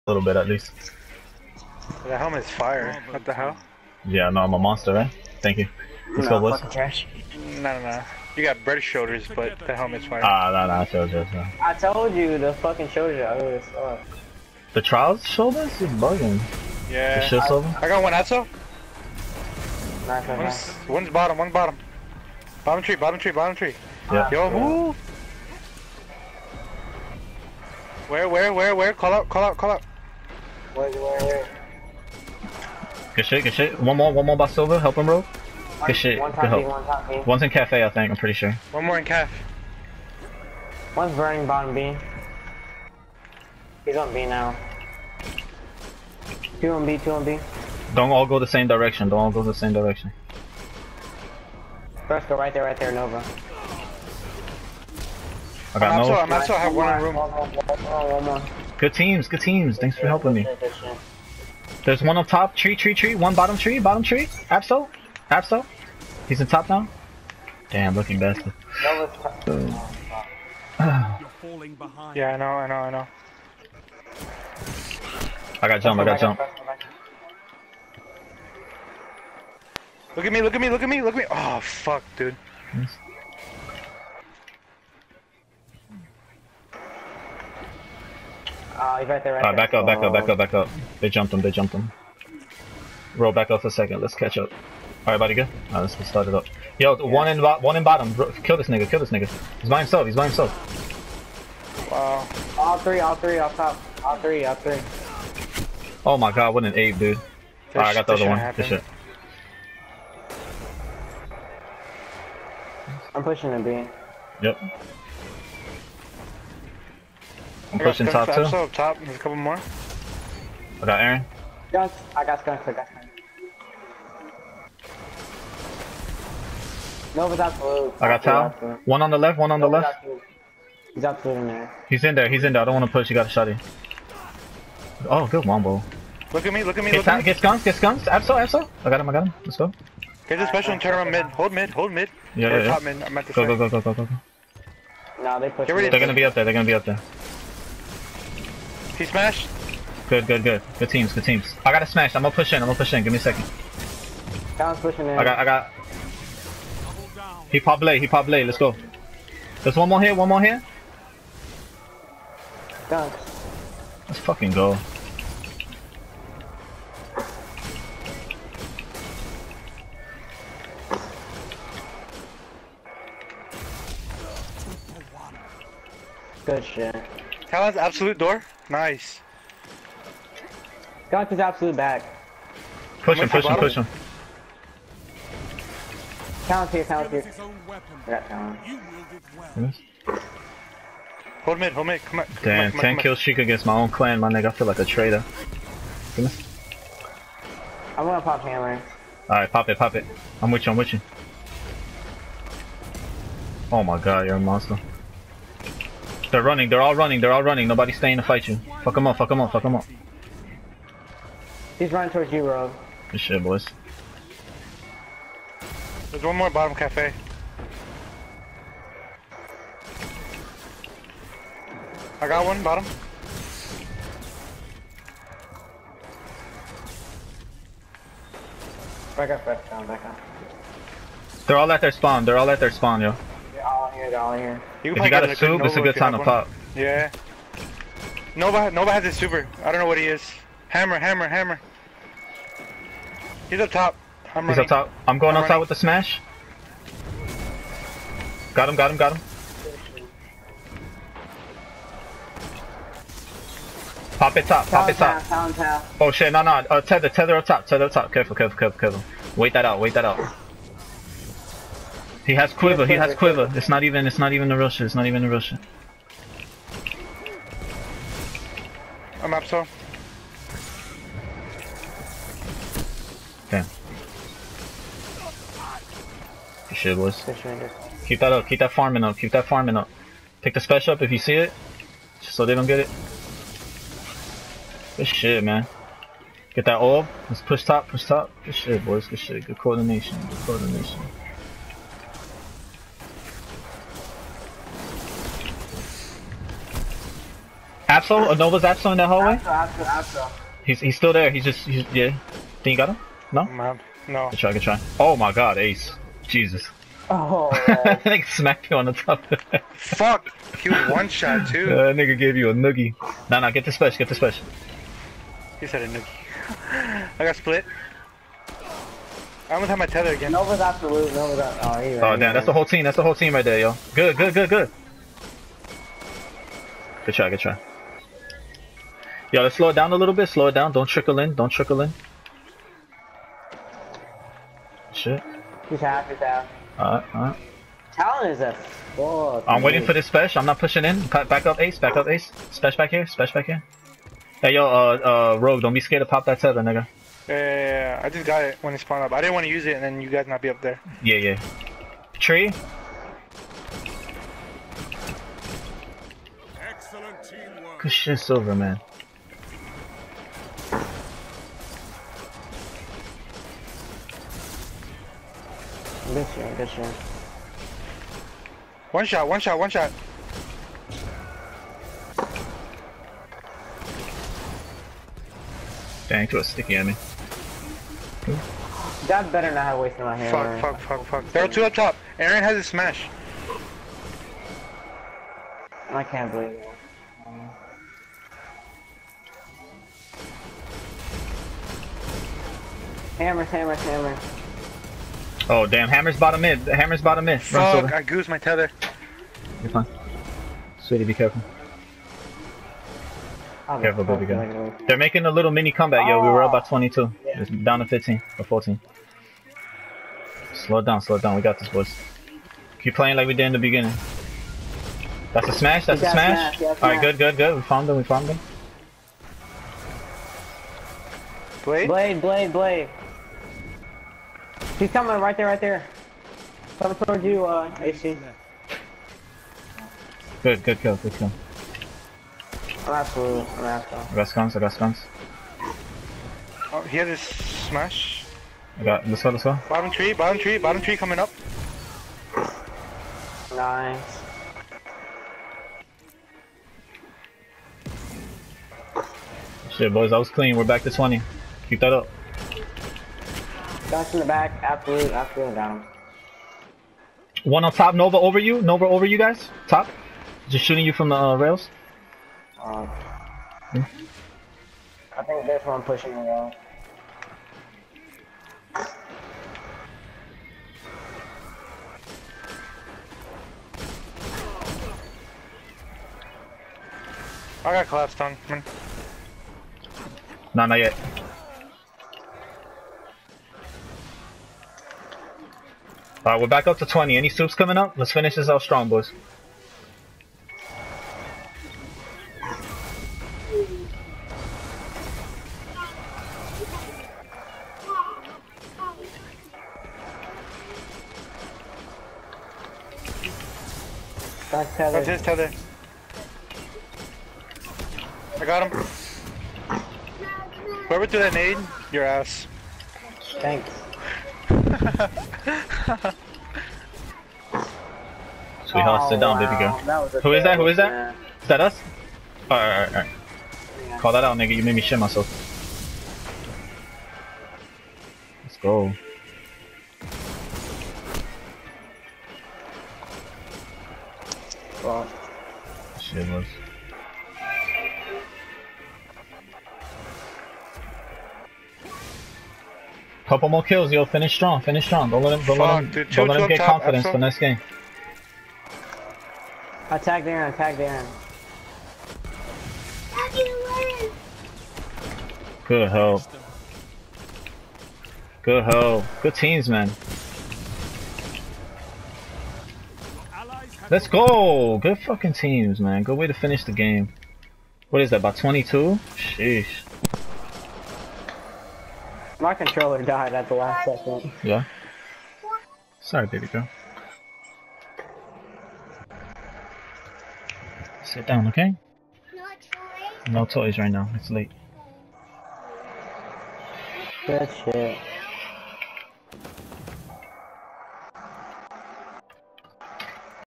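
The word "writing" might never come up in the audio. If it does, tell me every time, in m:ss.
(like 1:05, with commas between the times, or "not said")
not said.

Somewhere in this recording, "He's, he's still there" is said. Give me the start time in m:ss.
5:00.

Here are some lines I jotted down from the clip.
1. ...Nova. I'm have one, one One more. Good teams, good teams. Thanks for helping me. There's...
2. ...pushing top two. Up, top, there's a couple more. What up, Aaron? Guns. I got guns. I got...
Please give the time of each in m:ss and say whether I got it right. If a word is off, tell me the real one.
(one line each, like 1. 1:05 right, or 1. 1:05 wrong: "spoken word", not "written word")
1. 0:56 right
2. 1:57 right.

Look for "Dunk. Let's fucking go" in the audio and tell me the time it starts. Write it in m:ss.
2:42.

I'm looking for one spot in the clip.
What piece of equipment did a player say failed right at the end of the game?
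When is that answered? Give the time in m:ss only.
9:32.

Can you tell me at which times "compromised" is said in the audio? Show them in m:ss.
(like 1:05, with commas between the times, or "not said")
not said.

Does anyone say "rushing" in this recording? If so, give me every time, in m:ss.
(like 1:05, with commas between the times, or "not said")
not said.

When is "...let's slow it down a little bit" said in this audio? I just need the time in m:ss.
5:29.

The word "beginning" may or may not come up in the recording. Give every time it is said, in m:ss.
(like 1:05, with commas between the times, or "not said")
6:53.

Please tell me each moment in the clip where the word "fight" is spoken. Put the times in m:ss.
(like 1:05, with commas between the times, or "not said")
3:28.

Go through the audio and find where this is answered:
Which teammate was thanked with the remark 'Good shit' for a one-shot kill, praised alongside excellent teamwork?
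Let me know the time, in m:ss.
5:57.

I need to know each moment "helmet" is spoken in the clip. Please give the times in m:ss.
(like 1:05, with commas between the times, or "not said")
0:02, 0:09.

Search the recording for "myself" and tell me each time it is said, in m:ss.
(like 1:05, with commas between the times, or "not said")
8:44.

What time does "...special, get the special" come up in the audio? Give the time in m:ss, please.
5:13.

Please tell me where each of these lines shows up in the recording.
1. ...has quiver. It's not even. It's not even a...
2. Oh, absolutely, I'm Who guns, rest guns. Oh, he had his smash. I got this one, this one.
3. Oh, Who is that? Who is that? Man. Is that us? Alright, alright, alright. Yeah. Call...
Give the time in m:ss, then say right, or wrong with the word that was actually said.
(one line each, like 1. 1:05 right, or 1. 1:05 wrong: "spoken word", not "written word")
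1. 4:22 right
2. 7:12 wrong: "Rest", not "Who"
3. 8:40 right.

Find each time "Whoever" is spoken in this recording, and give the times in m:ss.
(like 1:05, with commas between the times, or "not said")
8:30.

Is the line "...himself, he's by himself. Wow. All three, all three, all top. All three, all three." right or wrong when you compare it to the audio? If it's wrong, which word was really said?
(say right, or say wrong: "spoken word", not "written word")
right.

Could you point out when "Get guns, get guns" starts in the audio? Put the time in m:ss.
2:17.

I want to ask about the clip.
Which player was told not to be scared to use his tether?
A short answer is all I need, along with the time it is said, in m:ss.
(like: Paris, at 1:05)
Rogue, at 5:45.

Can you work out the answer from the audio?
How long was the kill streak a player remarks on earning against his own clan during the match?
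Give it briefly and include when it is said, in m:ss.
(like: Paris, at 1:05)
10, at 3:12.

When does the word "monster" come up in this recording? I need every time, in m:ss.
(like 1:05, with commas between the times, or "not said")
0:04, 3:24.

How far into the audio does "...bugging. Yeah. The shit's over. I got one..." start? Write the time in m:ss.
0:15.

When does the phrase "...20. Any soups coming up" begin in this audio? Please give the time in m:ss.
8:06.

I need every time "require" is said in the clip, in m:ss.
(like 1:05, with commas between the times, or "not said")
not said.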